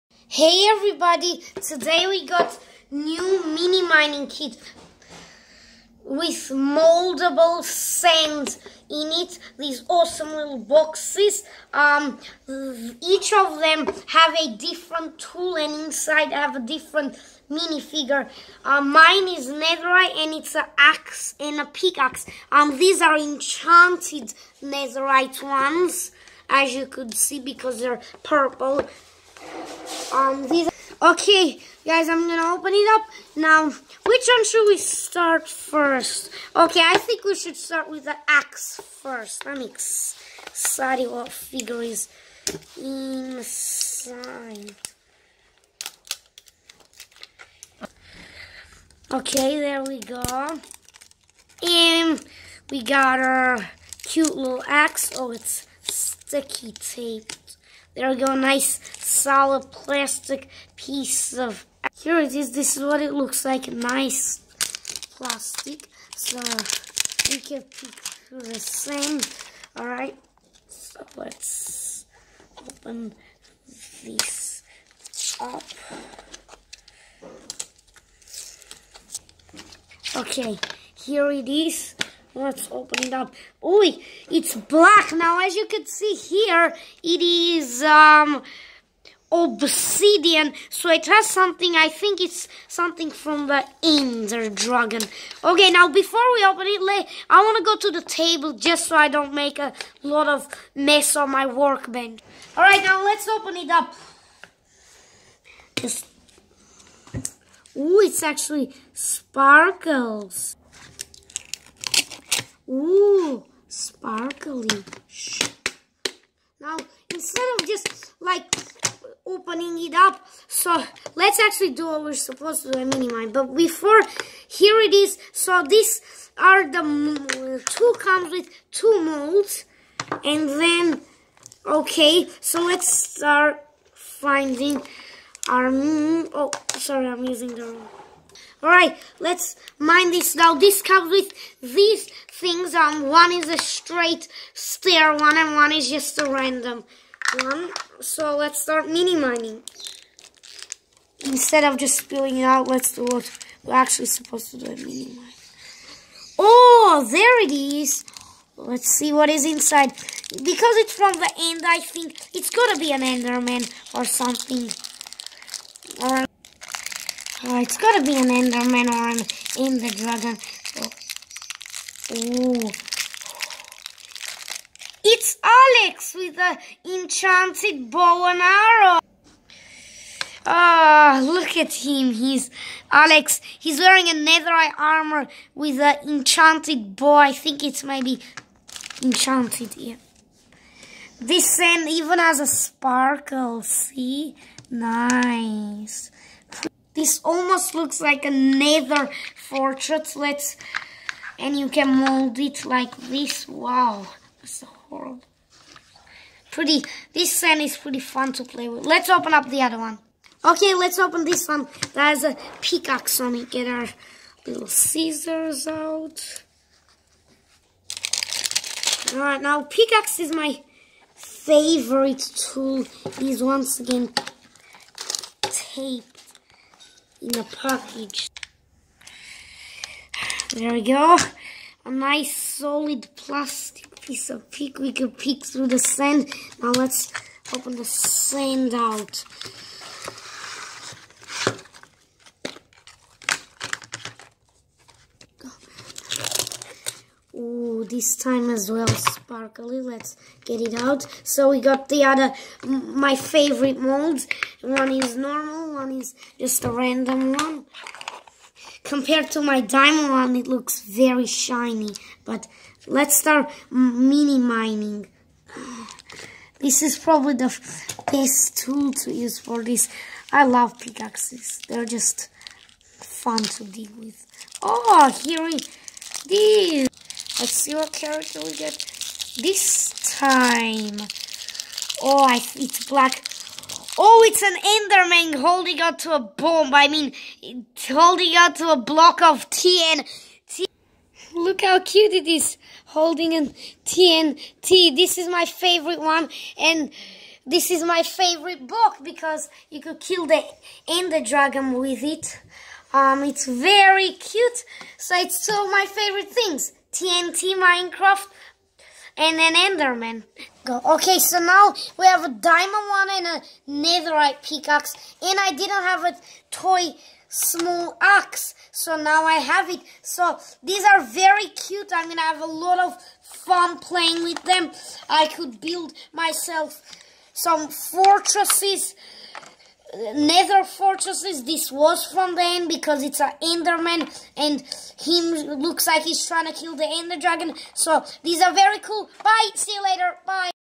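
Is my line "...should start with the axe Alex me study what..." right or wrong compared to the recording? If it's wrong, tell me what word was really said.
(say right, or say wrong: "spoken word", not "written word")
wrong: "Let", not "Alex".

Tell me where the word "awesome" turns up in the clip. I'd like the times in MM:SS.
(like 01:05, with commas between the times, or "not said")
00:09.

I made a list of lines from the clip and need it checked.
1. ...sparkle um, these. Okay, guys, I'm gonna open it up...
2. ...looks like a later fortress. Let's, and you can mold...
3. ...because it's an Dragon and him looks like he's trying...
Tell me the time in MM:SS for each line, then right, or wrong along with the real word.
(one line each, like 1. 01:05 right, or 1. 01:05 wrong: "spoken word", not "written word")
1. 00:28 wrong: "purple", not "sparkle"
2. 03:17 wrong: "nether", not "later"
3. 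05:32 wrong: "Enderman", not "Dragon".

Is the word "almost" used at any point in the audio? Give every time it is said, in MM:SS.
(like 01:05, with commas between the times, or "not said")
03:17.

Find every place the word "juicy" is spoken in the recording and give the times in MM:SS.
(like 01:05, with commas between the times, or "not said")
not said.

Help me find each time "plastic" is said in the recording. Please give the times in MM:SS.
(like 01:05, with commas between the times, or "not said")
00:59, 01:05, 03:53.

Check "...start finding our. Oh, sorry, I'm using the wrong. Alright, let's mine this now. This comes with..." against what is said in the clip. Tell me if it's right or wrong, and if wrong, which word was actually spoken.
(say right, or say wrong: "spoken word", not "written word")
right.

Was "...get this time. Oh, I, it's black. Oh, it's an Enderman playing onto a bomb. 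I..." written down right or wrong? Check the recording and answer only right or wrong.
wrong.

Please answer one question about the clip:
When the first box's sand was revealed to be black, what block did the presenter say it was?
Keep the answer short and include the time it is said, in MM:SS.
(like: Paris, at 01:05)
Obsidian, at 01:29.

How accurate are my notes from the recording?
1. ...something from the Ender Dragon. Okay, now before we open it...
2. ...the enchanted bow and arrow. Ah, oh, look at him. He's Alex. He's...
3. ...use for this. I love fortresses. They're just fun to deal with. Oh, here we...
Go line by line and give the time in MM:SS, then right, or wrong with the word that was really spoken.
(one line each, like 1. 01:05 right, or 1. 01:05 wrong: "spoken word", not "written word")
1. 01:32 right
2. 02:56 right
3. 04:29 wrong: "pickaxes", not "fortresses".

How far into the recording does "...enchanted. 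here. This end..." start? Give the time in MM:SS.
03:09.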